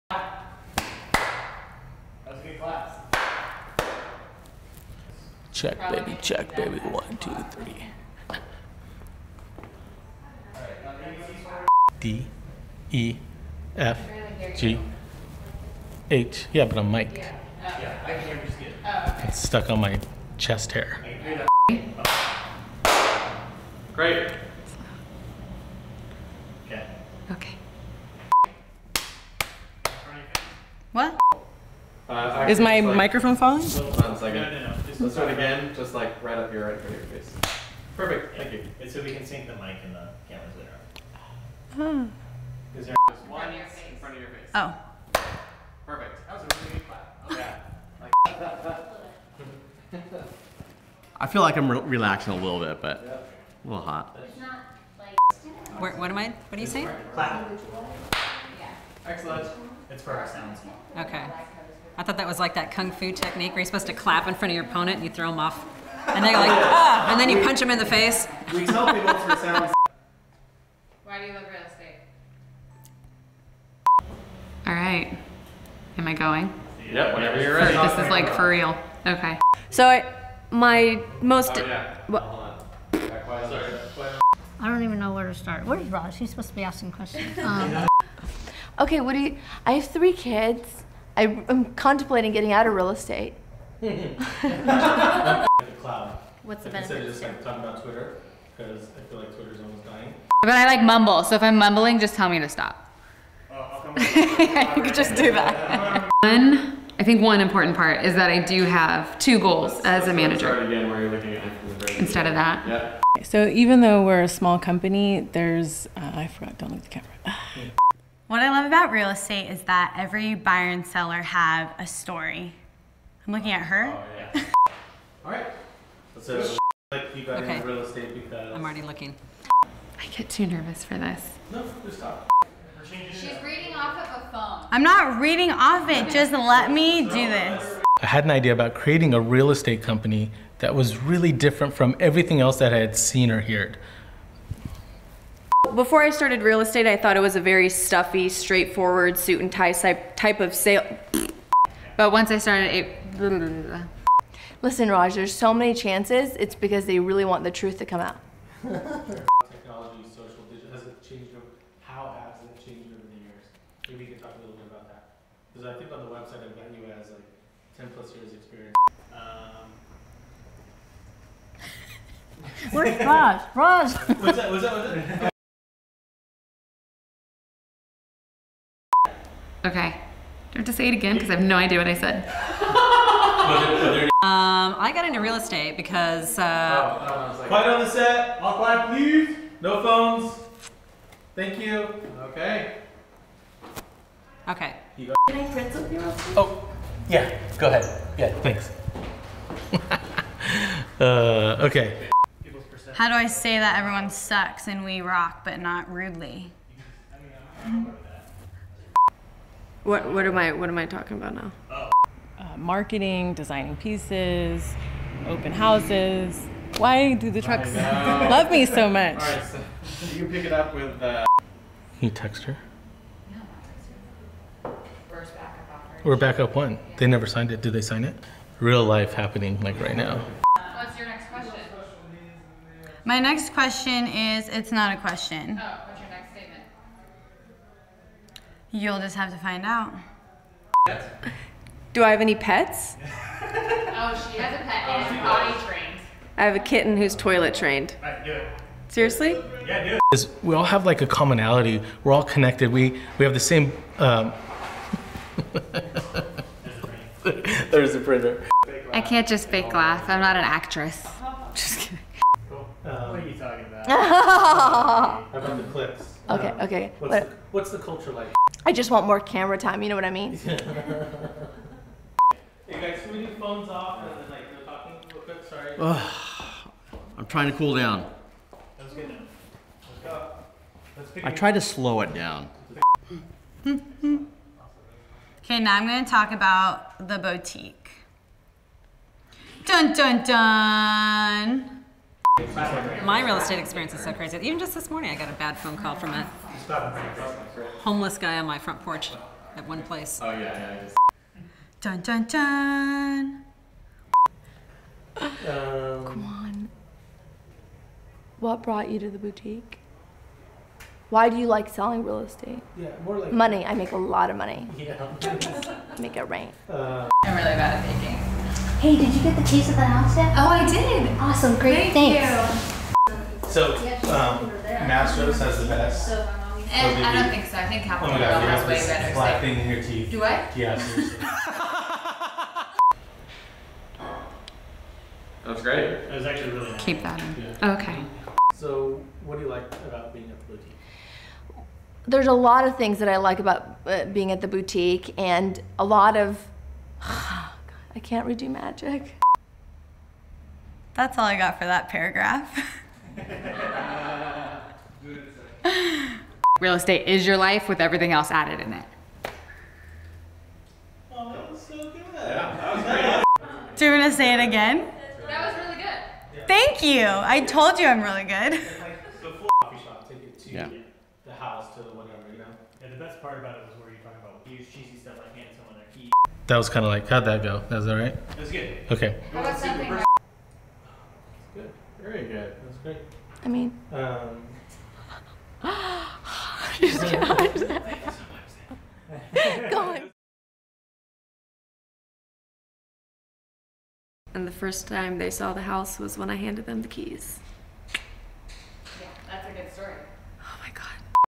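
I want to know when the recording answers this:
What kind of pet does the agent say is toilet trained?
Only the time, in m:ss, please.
4:06.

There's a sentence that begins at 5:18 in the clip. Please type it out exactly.
Hey, did you get the cheese at the house yet?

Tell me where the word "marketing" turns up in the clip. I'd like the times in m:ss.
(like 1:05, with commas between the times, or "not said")
3:32.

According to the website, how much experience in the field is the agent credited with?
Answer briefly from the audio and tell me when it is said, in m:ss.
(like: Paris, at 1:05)
10 plus years, at 2:47.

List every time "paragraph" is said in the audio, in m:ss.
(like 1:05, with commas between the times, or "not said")
5:51.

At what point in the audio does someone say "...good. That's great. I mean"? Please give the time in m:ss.
6:22.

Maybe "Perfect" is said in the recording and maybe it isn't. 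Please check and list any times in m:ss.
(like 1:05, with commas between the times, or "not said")
0:37, 0:45.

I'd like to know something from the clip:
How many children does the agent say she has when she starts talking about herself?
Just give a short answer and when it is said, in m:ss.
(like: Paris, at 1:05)
3, at 1:29.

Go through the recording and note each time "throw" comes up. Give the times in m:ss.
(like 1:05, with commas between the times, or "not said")
1:05.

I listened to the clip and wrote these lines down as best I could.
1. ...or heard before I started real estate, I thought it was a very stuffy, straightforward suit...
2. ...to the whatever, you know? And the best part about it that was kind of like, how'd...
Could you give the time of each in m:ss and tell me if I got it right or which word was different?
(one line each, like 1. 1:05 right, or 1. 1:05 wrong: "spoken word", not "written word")
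1. 2:23 right
2. 6:11 right.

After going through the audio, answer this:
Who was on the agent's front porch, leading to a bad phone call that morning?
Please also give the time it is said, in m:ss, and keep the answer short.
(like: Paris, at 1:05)
A homeless guy, at 4:57.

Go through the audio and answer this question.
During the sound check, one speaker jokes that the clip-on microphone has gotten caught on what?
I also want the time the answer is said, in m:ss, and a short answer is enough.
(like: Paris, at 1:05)
Chest hair, at 0:20.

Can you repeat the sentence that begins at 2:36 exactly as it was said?
It's because they really want the truth to come out.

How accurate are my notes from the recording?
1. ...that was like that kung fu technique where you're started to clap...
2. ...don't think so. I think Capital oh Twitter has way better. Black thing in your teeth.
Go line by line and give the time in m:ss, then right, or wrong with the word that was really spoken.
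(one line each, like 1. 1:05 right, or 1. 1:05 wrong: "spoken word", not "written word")
1. 1:02 wrong: "supposed", not "started"
2. 5:27 wrong: "Grill", not "Twitter".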